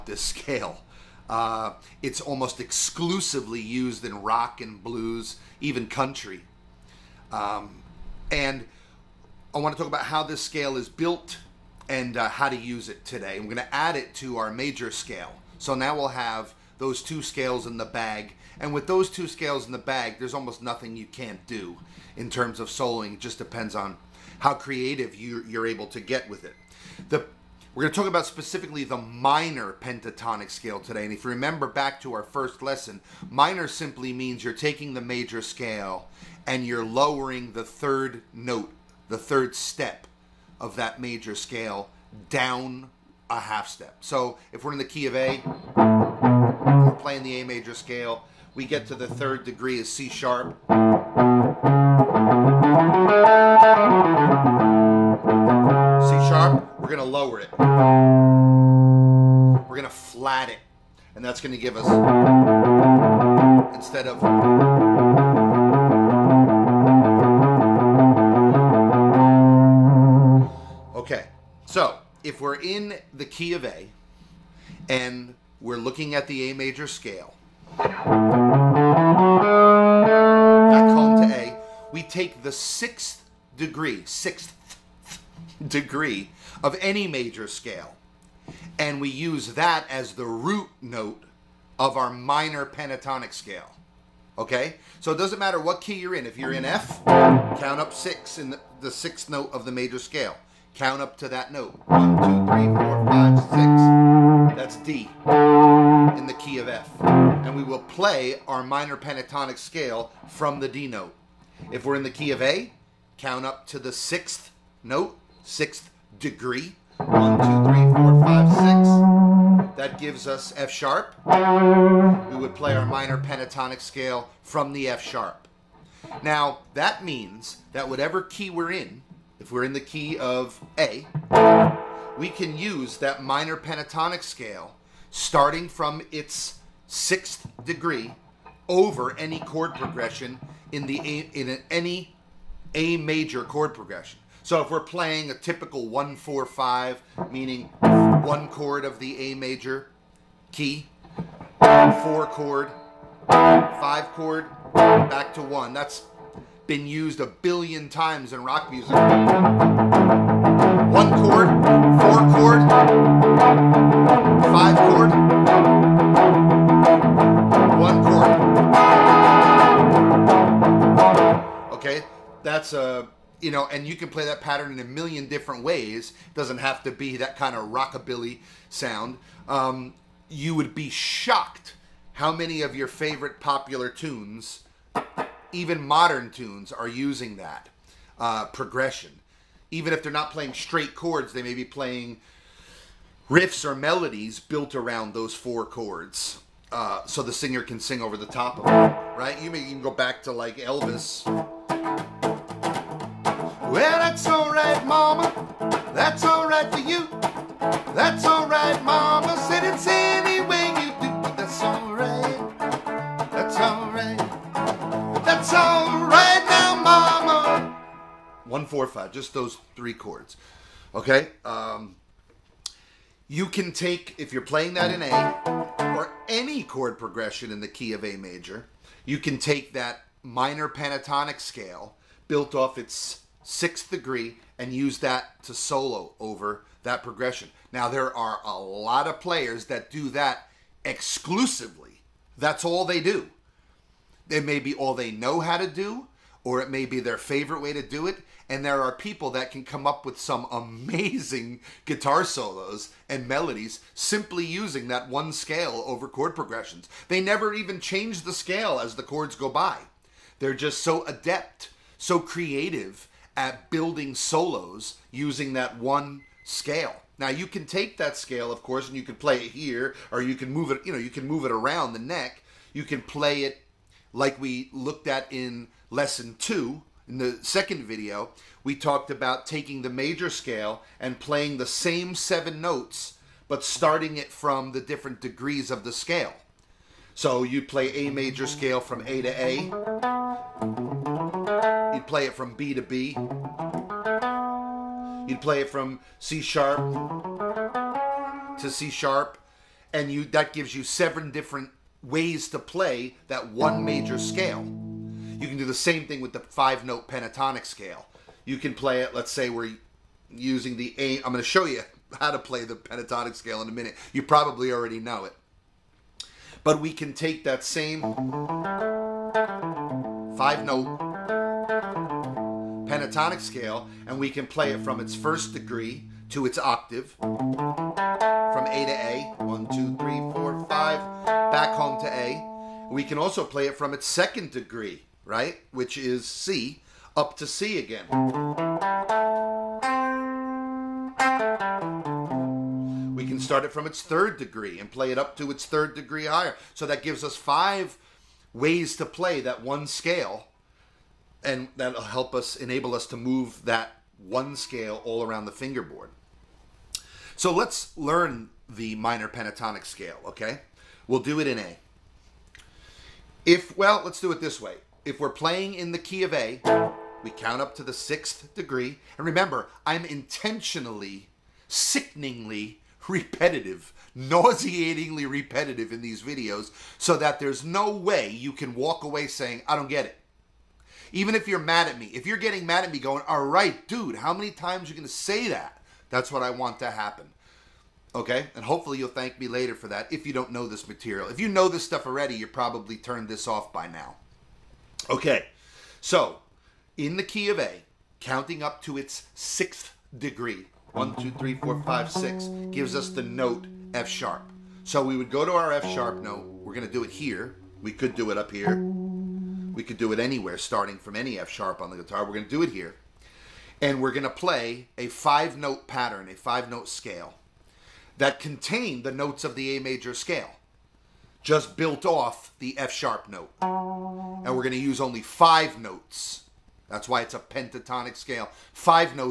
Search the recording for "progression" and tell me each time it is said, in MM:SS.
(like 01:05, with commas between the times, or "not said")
02:19, 02:23, 03:08, 03:46, 03:57, 04:16.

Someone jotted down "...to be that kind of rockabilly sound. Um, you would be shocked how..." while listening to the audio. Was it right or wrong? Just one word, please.
right.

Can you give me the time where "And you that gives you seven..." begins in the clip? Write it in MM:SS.
04:59.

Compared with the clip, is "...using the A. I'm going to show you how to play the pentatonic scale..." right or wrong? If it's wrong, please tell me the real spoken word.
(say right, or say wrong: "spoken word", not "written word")
right.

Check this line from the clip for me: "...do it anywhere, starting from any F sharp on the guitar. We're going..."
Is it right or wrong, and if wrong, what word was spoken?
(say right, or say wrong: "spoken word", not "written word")
right.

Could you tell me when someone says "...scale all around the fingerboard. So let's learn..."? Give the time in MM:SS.
05:54.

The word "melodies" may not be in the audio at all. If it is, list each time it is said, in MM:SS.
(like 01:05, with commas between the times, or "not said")
03:13, 04:13.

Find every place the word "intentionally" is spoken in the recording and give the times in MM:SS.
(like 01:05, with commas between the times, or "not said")
06:10.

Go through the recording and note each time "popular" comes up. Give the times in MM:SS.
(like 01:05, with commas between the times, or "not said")
03:03.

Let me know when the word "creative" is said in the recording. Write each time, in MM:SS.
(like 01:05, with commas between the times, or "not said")
00:24, 04:22.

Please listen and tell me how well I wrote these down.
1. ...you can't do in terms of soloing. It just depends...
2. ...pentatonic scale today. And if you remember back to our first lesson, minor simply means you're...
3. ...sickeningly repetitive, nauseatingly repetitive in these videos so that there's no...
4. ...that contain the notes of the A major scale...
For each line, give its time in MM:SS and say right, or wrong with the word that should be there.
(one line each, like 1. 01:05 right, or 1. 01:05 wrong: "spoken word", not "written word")
1. 00:20 right
2. 00:29 right
3. 06:11 right
4. 06:58 right.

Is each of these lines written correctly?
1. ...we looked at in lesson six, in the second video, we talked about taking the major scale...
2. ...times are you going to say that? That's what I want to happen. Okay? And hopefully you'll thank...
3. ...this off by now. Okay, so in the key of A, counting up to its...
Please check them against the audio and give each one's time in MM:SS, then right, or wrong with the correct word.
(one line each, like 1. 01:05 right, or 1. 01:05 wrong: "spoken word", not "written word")
1. 04:34 wrong: "two", not "six"
2. 06:24 right
3. 06:33 right.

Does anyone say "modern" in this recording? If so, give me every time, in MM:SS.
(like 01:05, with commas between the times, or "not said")
03:05.